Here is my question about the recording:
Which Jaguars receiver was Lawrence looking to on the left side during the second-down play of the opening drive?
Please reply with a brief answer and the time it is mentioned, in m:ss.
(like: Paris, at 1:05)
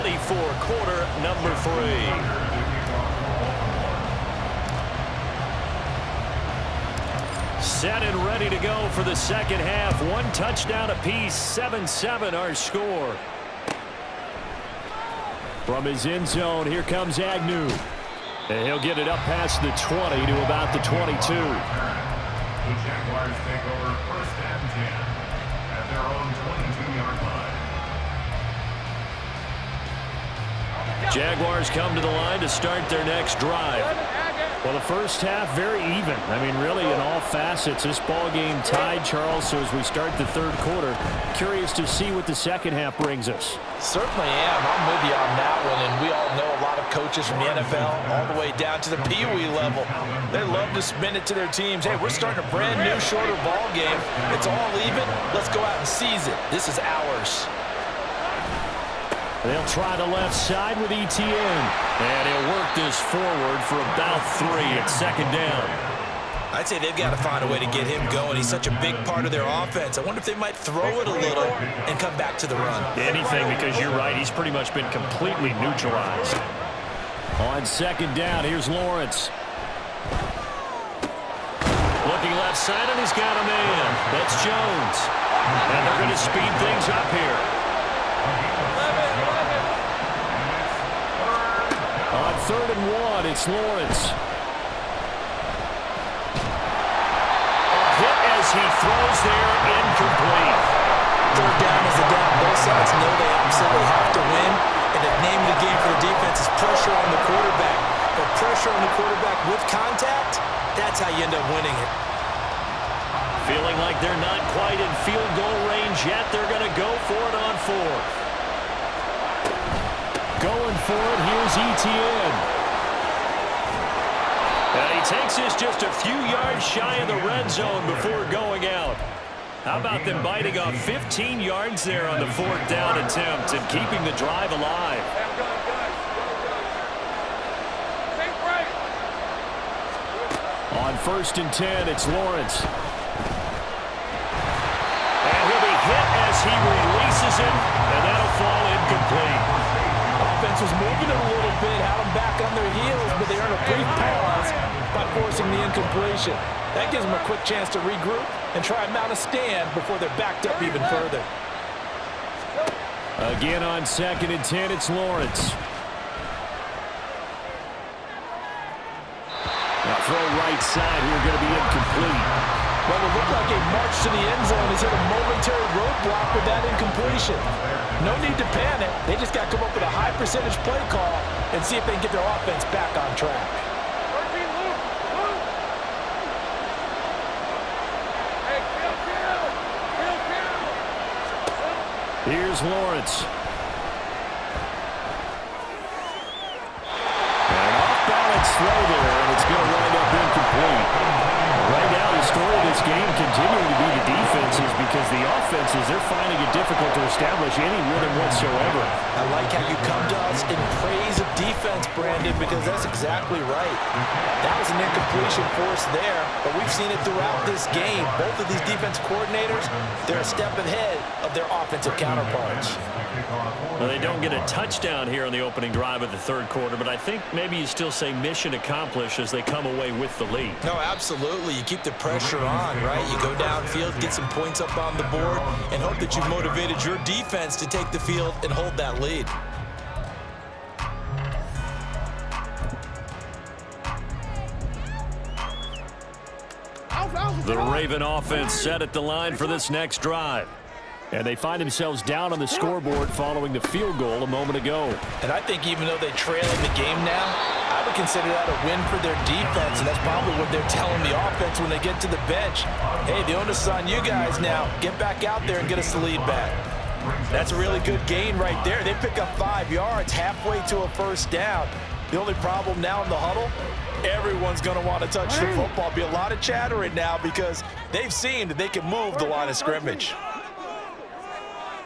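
Jones, at 1:24.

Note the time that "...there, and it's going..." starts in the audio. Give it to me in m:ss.
3:18.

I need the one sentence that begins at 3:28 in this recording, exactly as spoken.
I like how you come to us in praise of defense, Brandon, because that's exactly right.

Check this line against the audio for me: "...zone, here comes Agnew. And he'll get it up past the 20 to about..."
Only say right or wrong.
right.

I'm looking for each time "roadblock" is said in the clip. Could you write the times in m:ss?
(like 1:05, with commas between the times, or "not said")
2:55.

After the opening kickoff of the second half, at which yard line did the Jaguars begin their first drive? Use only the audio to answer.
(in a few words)
22.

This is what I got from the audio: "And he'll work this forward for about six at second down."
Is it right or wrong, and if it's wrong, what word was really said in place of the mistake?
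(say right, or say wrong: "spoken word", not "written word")
wrong: "three", not "six".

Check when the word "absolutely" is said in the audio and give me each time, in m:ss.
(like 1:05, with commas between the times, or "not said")
1:43, 3:50.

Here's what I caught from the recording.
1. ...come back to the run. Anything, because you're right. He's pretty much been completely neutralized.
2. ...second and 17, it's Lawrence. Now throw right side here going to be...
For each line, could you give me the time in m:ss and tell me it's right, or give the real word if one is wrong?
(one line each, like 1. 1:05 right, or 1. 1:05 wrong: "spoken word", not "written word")
1. 1:11 right
2. 2:43 wrong: "10", not "17".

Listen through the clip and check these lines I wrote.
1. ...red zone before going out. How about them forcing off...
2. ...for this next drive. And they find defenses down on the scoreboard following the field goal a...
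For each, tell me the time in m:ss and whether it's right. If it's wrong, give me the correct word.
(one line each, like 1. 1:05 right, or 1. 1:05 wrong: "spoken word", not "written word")
1. 2:07 wrong: "biting", not "forcing"
2. 4:09 wrong: "themselves", not "defenses".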